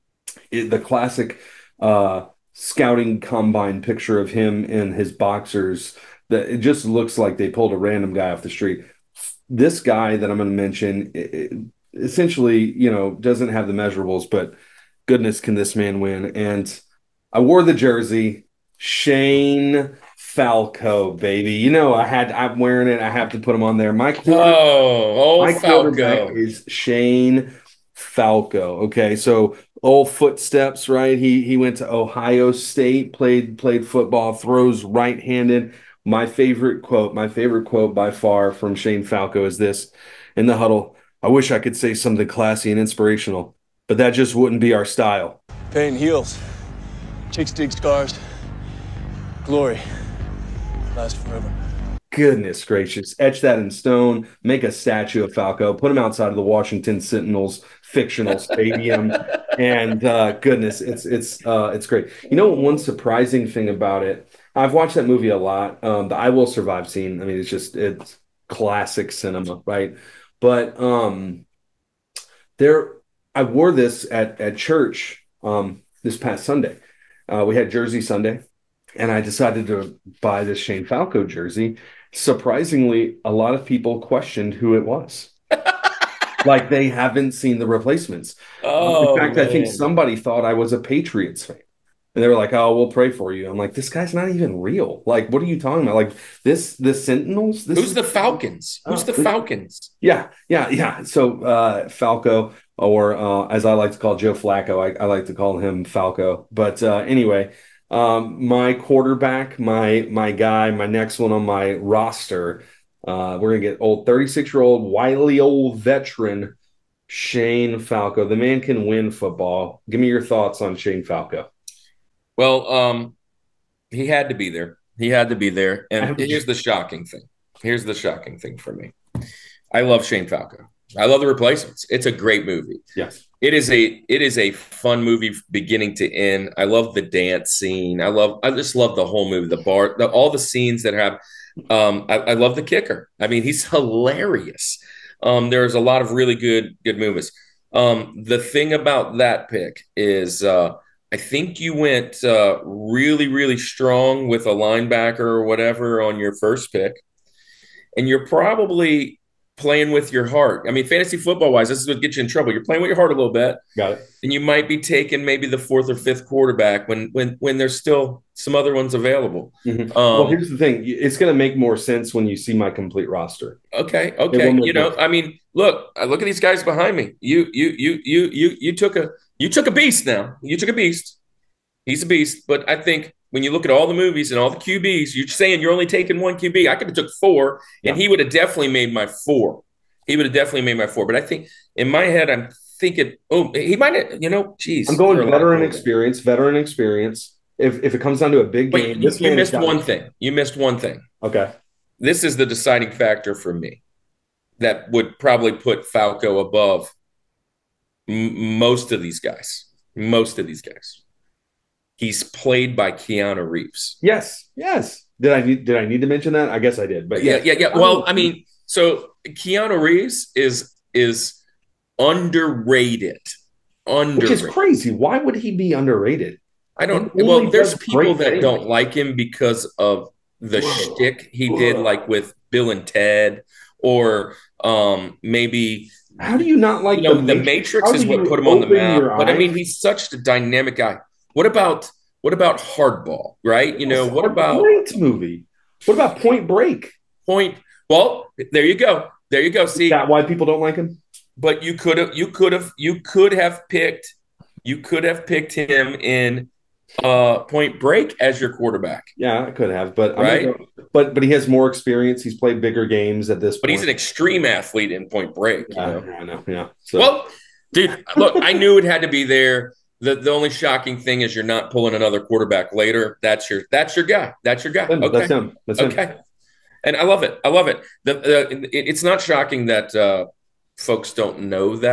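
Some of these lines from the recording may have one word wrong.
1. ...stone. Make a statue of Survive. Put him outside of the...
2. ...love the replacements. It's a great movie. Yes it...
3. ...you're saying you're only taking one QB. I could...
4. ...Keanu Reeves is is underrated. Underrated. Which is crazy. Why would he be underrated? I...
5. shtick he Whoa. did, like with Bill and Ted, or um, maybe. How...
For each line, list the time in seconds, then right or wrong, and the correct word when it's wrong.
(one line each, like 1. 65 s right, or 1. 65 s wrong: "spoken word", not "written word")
1. 53 s wrong: "Falco", not "Survive"
2. 131 s right
3. 185 s right
4. 219 s right
5. 230 s right.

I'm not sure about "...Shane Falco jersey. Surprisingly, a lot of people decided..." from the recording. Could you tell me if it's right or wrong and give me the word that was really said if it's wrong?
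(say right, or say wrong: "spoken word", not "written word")
wrong: "questioned", not "decided".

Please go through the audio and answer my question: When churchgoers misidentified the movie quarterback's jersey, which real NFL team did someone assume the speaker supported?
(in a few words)
Patriots.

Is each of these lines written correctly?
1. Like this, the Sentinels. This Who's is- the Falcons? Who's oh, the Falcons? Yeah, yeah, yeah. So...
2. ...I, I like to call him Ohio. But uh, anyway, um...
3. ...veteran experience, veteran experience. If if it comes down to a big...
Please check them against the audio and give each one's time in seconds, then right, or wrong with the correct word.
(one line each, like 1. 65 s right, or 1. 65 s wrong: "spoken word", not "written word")
1. 95 s right
2. 104 s wrong: "Falco", not "Ohio"
3. 195 s right.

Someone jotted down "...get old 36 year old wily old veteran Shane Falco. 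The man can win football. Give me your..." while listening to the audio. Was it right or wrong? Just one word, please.
right.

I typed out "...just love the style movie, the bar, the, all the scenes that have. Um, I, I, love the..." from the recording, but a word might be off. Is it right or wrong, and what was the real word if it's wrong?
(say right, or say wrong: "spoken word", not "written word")
wrong: "whole", not "style".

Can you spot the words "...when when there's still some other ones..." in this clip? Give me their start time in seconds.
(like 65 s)
167 s.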